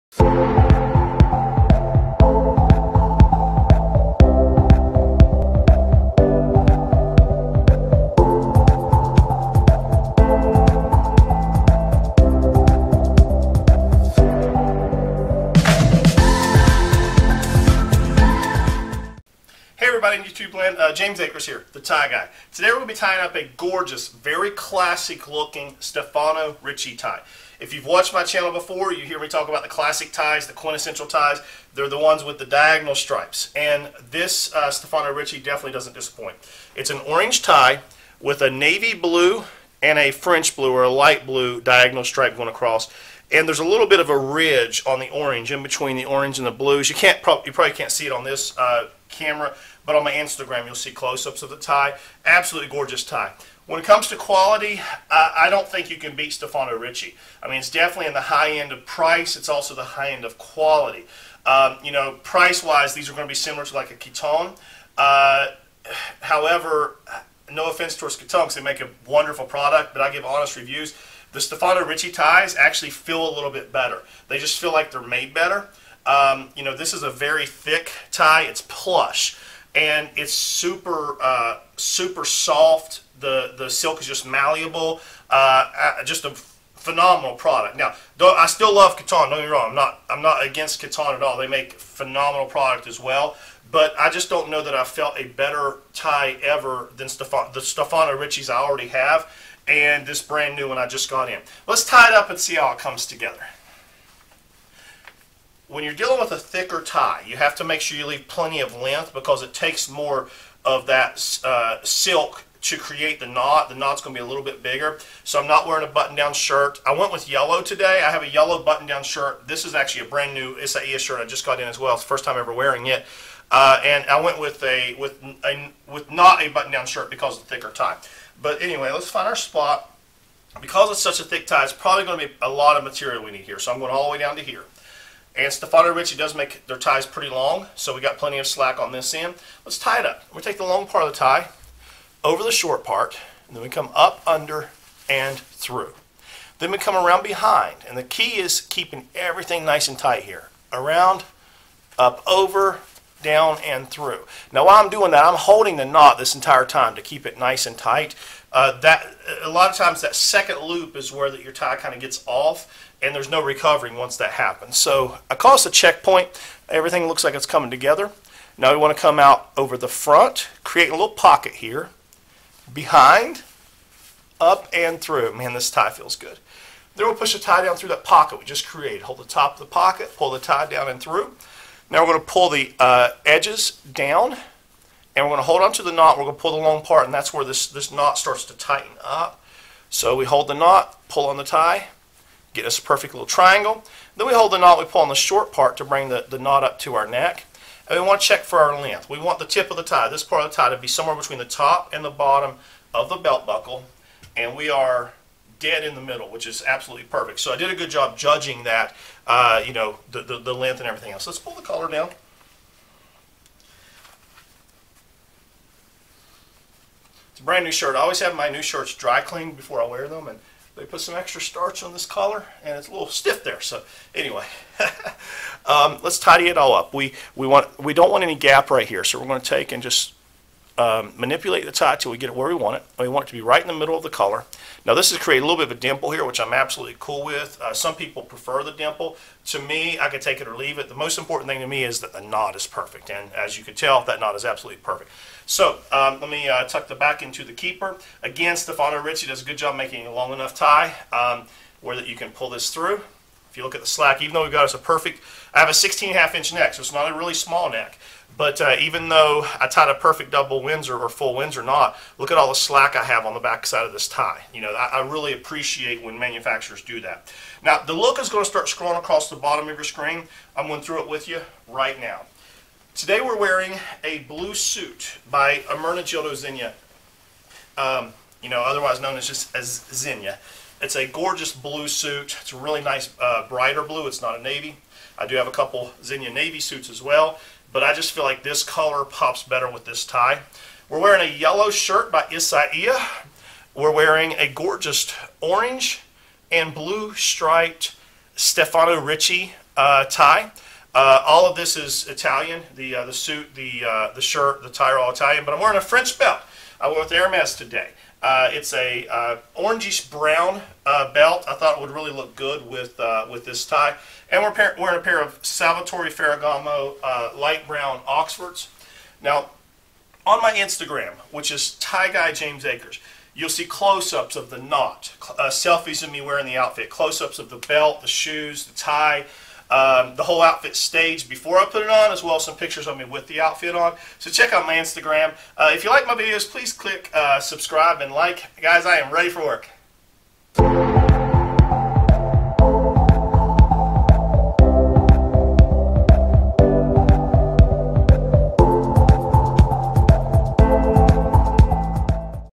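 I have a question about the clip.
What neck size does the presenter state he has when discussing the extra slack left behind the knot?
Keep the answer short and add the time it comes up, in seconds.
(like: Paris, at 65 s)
16 and a half inch, at 255 s.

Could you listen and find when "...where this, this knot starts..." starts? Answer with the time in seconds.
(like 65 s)
187 s.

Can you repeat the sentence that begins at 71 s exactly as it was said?
The Stefano Ricci ties actually feel a little bit better.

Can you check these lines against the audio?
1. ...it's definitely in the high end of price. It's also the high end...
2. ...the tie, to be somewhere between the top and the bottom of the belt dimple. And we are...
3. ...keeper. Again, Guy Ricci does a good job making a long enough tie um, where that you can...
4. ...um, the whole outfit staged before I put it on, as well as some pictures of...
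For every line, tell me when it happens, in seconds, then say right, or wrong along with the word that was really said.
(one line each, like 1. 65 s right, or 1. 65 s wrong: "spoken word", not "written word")
1. 57 s right
2. 200 s wrong: "buckle", not "dimple"
3. 247 s wrong: "Stefano", not "Guy"
4. 329 s right.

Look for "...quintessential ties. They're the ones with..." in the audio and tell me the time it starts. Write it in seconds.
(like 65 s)
30 s.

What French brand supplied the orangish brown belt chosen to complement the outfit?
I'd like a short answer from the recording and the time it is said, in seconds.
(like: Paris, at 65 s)
Hermes, at 307 s.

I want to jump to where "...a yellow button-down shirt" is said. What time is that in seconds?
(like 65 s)
118 s.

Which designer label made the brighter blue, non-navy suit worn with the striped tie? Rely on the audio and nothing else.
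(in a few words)
Ermenegildo Zegna.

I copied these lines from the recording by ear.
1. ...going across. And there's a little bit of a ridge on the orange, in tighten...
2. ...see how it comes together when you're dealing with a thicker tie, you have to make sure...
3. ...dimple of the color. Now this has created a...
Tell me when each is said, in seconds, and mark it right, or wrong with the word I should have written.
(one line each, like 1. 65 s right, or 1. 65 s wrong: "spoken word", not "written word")
1. 42 s wrong: "between", not "tighten"
2. 102 s right
3. 233 s wrong: "middle", not "dimple".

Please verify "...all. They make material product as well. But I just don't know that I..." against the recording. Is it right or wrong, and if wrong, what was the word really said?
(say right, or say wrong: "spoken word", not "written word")
wrong: "phenomenal", not "material".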